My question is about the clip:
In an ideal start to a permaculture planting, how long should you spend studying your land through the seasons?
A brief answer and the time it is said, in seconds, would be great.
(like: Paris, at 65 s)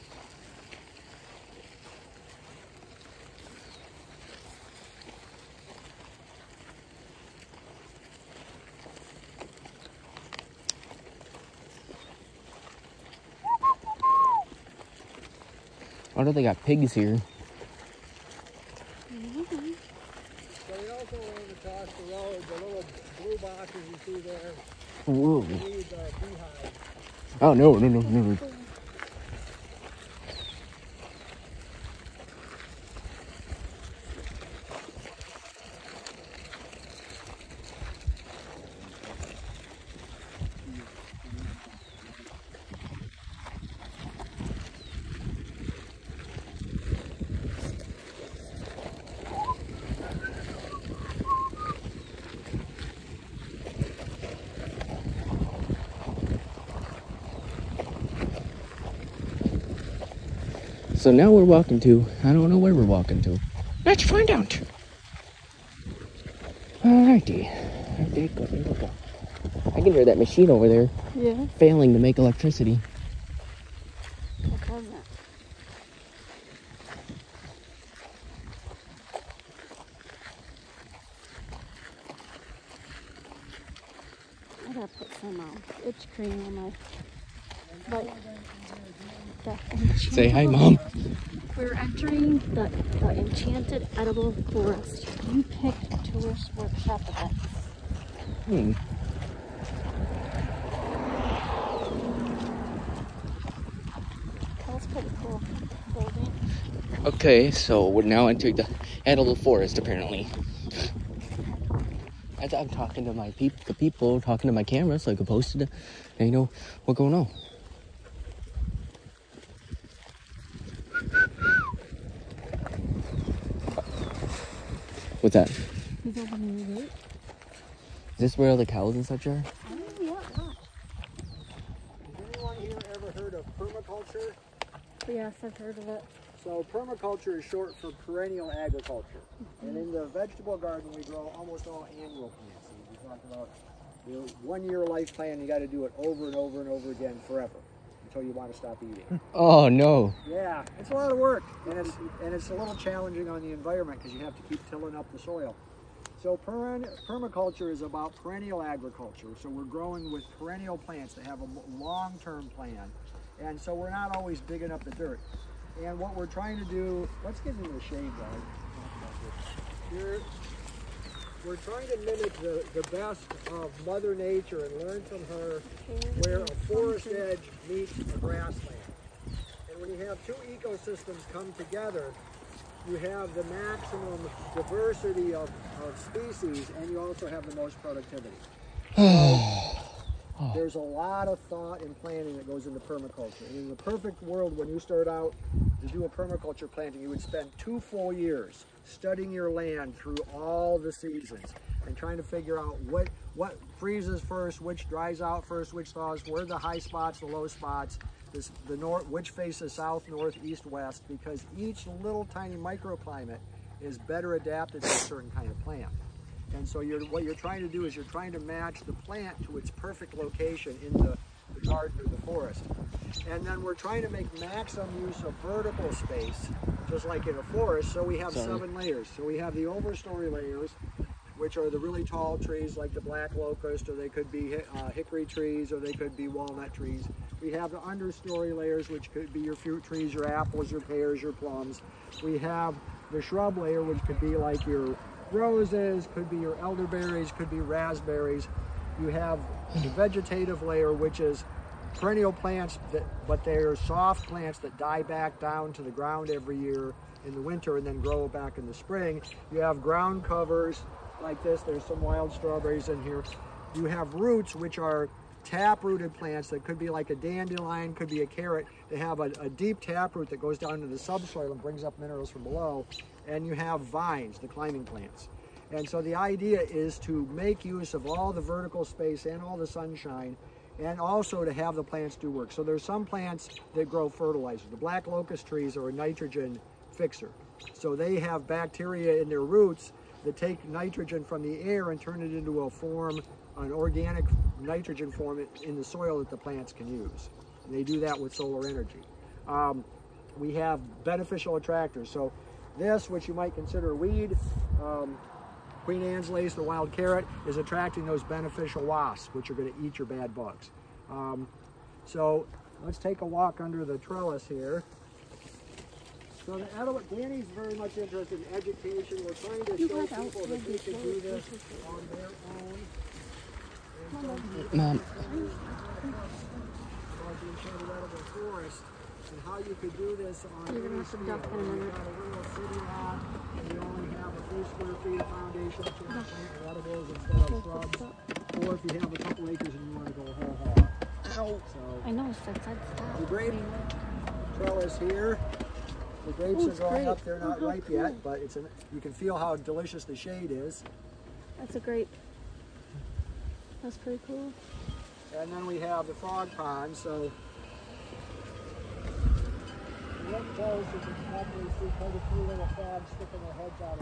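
2 years, at 197 s.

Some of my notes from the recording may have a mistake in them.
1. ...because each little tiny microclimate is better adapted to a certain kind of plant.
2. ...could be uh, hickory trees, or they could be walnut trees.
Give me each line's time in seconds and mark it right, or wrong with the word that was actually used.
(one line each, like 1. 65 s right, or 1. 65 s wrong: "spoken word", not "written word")
1. 211 s right
2. 234 s right.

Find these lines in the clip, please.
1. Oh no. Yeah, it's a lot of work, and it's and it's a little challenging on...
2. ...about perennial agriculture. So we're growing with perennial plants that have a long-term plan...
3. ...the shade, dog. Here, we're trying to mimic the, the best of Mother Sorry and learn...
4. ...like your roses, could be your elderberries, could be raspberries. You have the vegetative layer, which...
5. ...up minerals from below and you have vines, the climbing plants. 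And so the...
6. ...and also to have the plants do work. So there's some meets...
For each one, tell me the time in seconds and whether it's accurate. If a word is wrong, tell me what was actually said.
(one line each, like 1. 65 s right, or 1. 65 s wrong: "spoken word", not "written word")
1. 149 s right
2. 157 s right
3. 167 s wrong: "Nature", not "Sorry"
4. 244 s right
5. 271 s right
6. 280 s wrong: "plants", not "meets".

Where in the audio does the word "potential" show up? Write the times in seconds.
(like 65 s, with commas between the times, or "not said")
not said.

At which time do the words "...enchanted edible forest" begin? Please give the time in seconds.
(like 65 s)
93 s.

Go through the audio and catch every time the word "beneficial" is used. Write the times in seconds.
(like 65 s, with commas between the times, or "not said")
301 s, 308 s.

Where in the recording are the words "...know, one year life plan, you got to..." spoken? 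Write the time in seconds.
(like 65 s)
144 s.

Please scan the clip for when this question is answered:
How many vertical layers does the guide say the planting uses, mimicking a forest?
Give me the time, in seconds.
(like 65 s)
228 s.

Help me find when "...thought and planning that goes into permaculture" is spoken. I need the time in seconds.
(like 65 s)
191 s.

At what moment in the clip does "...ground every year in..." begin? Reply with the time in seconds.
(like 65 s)
255 s.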